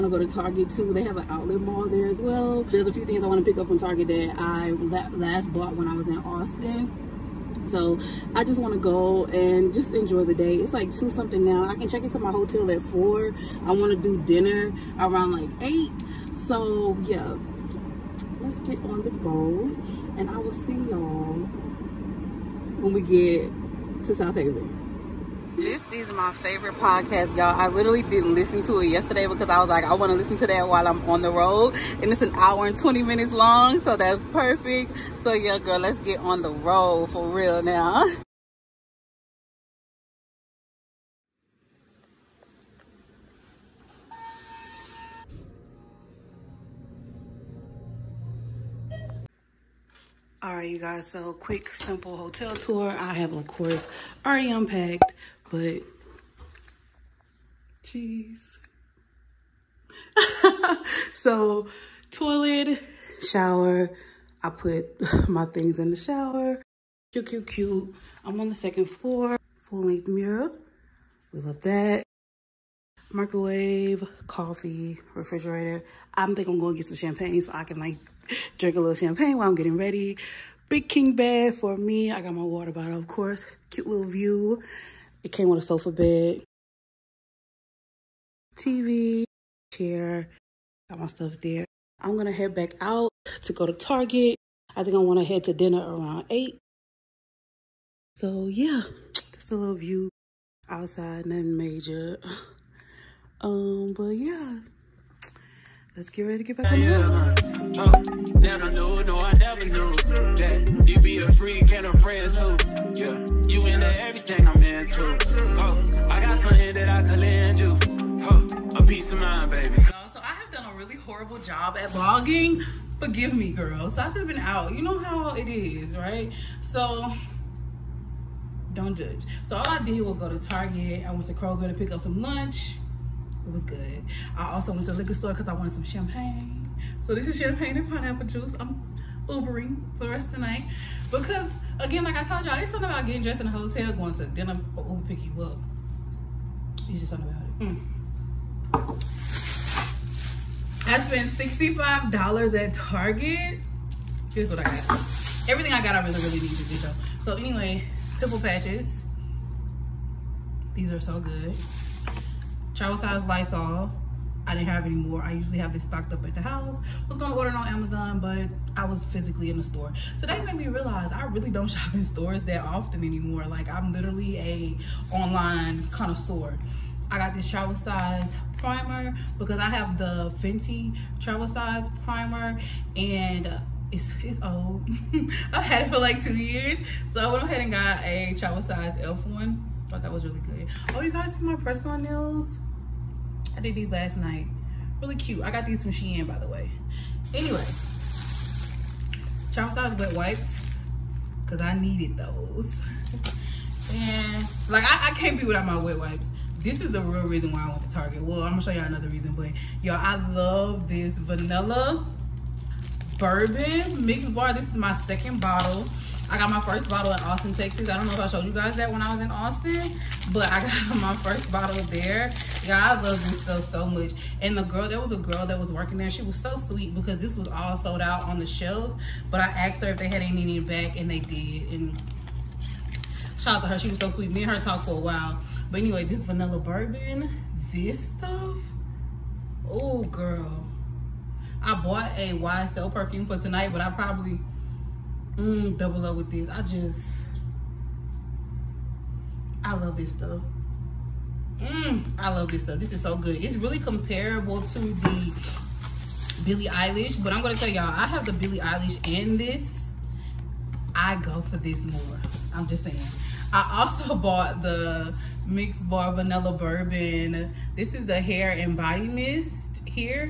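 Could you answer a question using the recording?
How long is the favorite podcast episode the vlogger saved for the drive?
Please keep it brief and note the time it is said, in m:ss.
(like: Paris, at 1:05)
1 hour 20 minutes, at 0:32.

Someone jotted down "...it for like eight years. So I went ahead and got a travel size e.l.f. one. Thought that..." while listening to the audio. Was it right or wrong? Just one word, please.
wrong.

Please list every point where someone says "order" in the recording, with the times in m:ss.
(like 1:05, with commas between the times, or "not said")
2:47.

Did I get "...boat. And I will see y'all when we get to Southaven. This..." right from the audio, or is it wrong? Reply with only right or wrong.
right.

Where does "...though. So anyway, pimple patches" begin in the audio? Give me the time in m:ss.
2:36.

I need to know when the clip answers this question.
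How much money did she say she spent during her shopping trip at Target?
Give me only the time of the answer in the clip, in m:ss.
2:31.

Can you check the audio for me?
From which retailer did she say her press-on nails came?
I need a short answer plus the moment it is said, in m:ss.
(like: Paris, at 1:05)
Shein, at 3:15.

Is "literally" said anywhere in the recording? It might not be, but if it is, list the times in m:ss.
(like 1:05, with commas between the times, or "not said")
0:27, 2:53.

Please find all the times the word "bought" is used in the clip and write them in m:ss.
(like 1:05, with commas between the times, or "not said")
0:05, 4:01, 4:24.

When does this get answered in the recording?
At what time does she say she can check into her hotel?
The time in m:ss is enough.
0:12.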